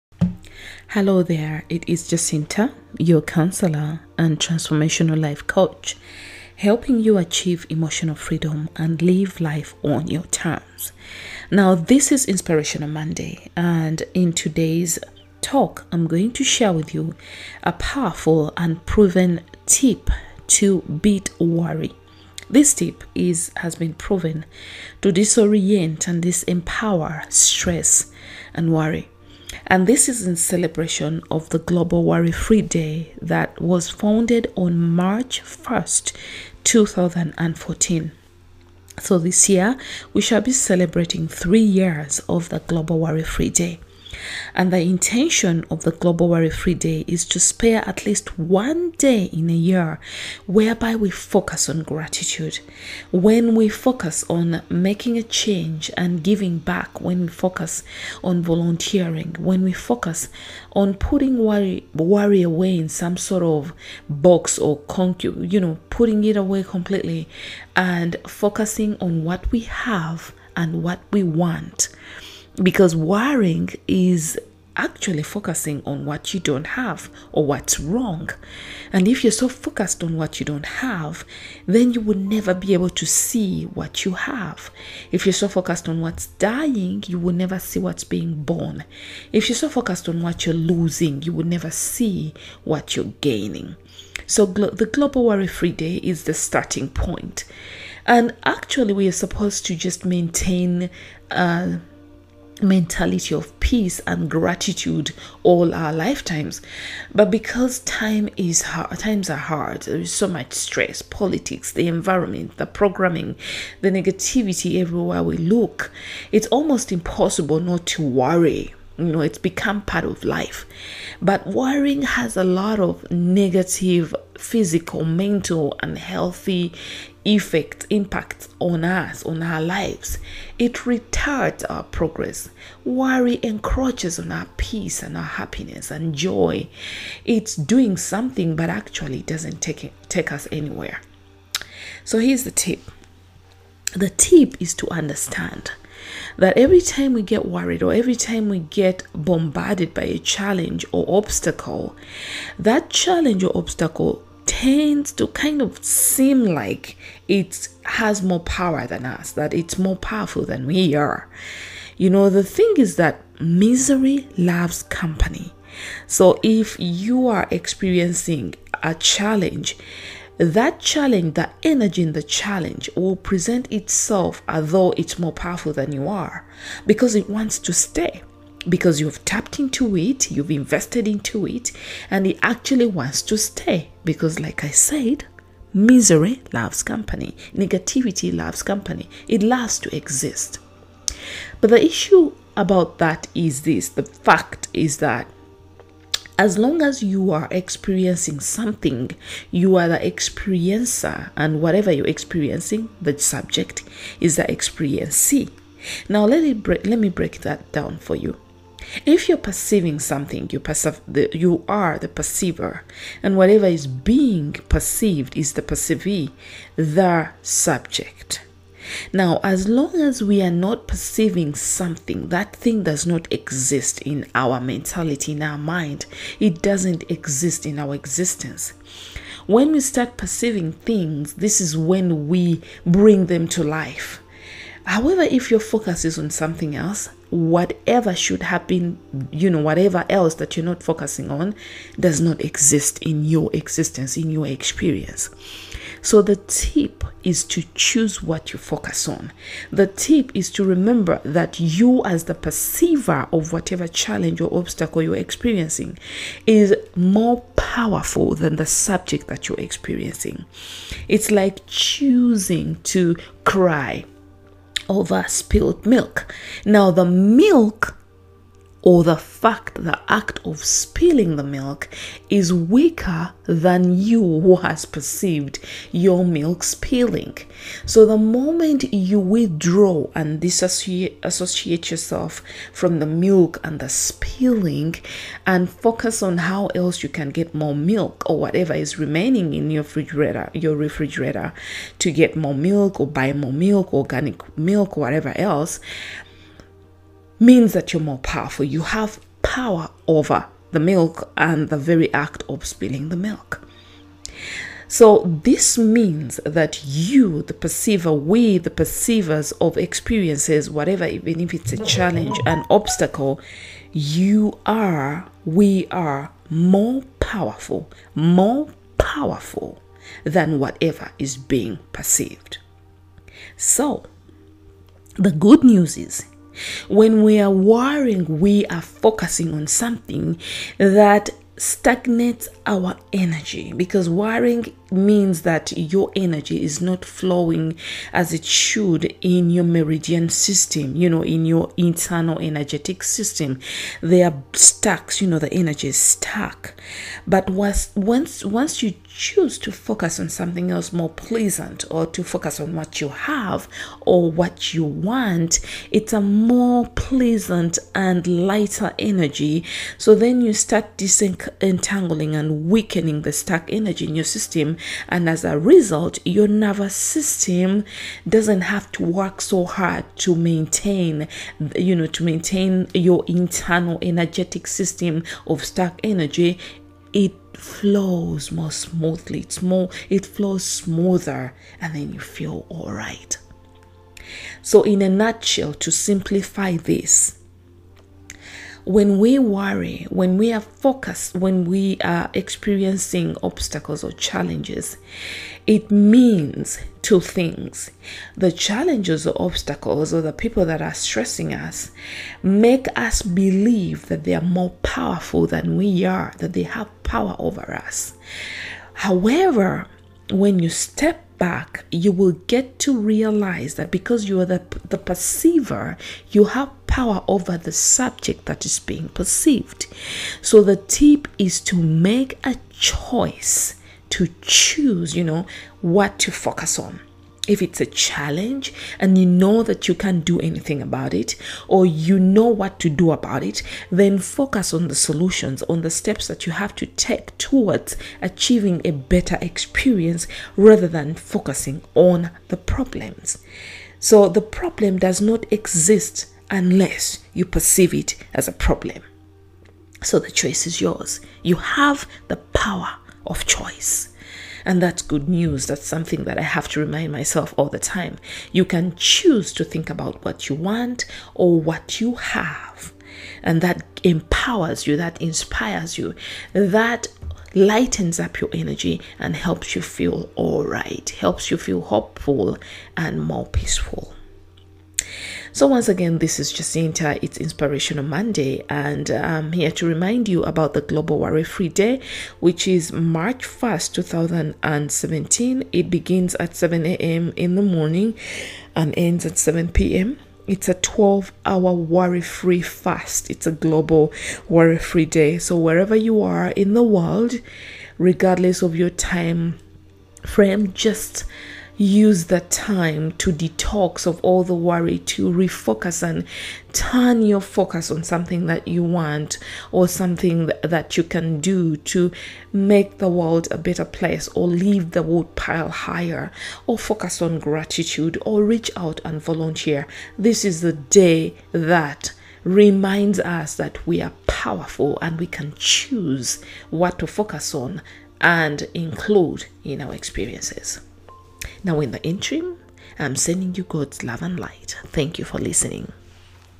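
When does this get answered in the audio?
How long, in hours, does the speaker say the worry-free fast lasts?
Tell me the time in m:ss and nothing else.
8:10.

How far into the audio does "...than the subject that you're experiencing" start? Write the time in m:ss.
4:18.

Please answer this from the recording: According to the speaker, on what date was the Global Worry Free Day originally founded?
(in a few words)
March 1st, 2014.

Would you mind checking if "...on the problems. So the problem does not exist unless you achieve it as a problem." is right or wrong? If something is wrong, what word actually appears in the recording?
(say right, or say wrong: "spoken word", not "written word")
wrong: "perceive", not "achieve".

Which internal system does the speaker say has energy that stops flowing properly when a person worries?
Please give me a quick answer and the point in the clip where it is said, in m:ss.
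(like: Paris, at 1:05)
meridian system, at 5:39.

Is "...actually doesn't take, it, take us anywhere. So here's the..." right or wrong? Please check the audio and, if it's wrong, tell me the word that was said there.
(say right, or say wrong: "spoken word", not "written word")
right.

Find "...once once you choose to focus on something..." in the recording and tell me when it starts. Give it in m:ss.
5:47.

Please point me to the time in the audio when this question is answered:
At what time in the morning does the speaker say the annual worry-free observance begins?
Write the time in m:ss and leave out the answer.
8:06.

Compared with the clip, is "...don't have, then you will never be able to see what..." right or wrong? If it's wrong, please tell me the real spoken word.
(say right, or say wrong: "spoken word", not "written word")
right.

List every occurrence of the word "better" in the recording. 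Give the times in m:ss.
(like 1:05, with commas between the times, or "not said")
7:18, 8:33.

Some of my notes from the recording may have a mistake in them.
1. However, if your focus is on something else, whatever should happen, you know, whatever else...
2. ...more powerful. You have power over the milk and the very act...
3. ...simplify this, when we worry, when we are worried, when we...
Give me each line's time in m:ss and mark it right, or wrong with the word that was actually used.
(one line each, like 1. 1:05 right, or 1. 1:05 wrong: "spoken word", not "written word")
1. 3:54 right
2. 4:58 right
3. 6:25 wrong: "focused", not "worried".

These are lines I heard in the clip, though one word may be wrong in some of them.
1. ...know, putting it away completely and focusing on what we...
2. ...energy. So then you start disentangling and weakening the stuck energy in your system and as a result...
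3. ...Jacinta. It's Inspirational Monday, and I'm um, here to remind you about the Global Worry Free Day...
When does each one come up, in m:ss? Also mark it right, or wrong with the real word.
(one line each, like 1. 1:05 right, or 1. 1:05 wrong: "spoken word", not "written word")
1. 1:05 right
2. 5:58 right
3. 7:56 right.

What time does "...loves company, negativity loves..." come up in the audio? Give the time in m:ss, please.
3:06.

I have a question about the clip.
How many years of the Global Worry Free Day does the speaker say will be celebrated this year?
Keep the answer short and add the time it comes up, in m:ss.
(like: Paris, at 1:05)
3, at 0:41.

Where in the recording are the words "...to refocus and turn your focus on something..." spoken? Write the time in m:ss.
8:24.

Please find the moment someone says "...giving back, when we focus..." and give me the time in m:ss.
0:56.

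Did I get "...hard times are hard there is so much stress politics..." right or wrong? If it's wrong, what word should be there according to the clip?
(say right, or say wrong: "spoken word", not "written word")
right.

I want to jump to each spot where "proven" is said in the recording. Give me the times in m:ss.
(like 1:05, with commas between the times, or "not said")
0:18, 0:23.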